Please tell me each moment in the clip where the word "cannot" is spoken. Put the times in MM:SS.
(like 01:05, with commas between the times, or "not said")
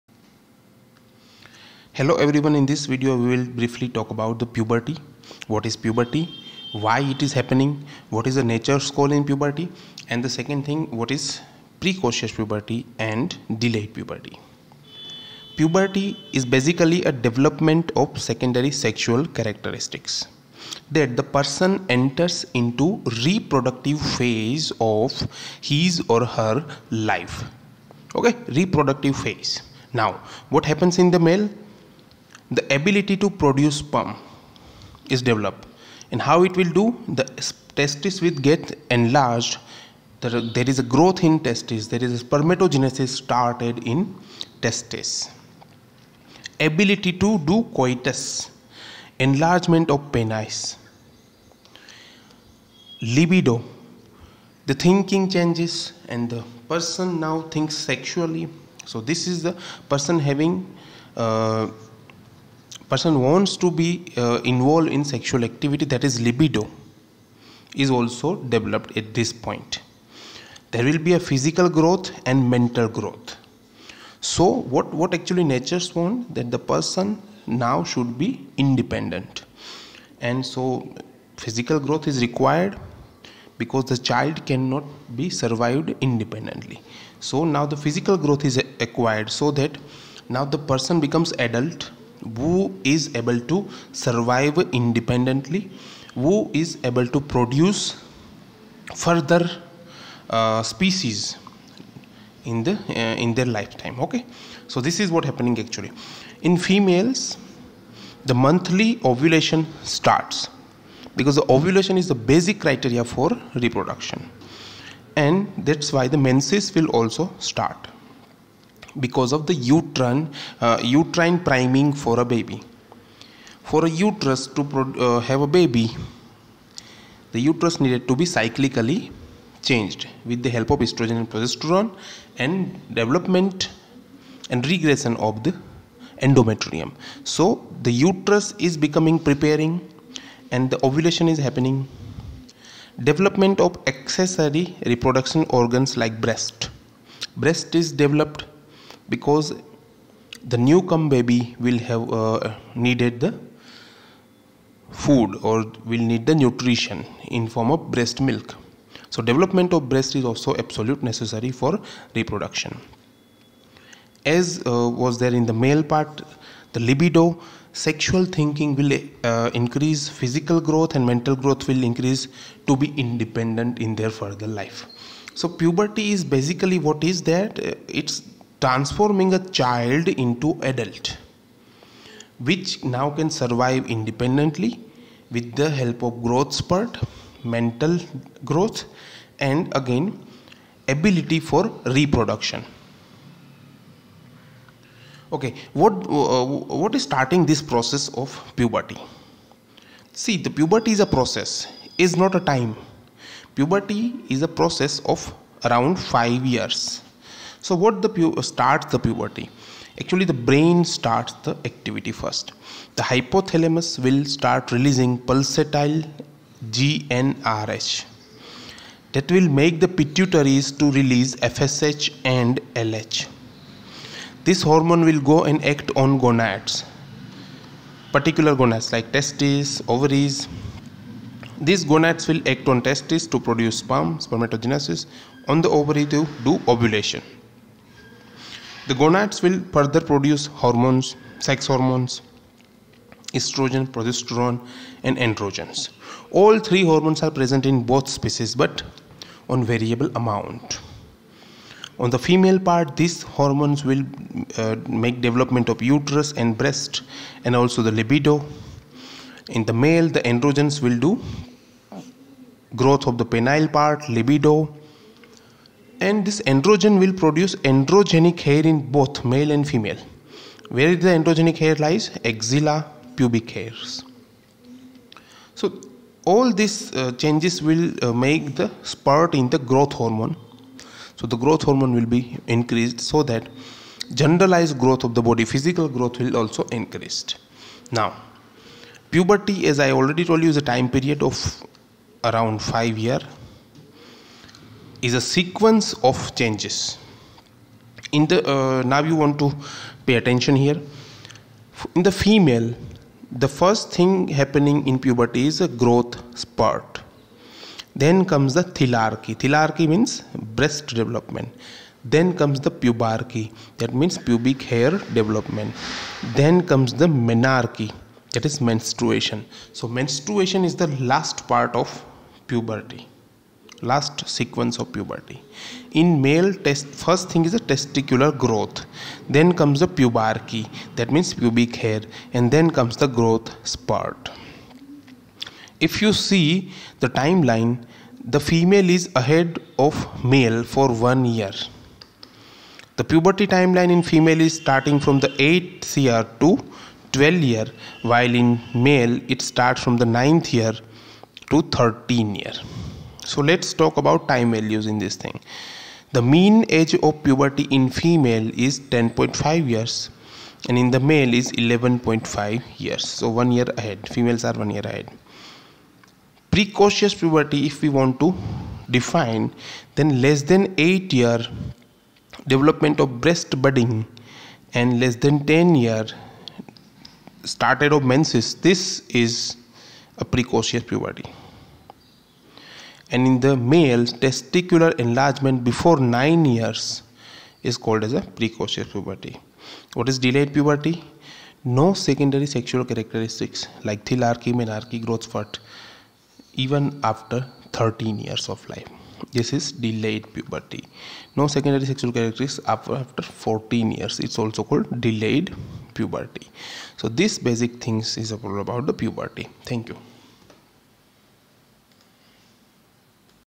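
01:24.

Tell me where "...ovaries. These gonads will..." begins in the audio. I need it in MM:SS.
03:49.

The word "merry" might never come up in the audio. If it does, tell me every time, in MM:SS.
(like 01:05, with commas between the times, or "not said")
not said.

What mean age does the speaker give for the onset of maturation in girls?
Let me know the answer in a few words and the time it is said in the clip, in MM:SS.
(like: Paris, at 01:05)
10.5 years, at 05:58.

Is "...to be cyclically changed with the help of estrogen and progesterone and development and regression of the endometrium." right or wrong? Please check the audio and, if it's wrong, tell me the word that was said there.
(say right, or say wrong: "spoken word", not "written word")
right.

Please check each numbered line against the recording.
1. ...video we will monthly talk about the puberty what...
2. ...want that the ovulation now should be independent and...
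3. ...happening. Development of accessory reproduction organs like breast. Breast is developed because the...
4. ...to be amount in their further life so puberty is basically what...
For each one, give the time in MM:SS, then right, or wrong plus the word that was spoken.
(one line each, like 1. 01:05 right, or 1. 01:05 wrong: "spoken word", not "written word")
1. 00:02 wrong: "briefly", not "monthly"
2. 01:15 wrong: "person", not "ovulation"
3. 02:21 right
4. 02:52 wrong: "independent", not "amount".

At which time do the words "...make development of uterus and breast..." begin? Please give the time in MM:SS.
04:14.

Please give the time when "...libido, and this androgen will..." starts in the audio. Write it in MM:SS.
04:24.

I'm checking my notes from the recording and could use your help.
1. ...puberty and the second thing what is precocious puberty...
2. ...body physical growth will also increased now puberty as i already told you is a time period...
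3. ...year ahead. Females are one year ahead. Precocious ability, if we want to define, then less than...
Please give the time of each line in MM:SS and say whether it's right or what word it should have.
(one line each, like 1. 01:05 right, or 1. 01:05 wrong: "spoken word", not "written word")
1. 00:09 right
2. 04:45 right
3. 06:03 wrong: "puberty", not "ability".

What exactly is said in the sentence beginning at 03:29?
Actually, the brain starts the activity first.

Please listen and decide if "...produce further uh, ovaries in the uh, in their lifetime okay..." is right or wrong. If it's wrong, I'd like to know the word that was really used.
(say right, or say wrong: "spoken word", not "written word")
wrong: "species", not "ovaries".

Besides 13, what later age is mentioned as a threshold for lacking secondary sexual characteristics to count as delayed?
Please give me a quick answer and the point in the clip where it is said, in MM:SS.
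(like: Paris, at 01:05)
14 years, at 06:43.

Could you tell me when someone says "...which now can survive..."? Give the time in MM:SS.
03:02.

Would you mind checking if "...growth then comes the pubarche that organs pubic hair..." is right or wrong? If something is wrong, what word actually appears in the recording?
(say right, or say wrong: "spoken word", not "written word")
wrong: "means", not "organs".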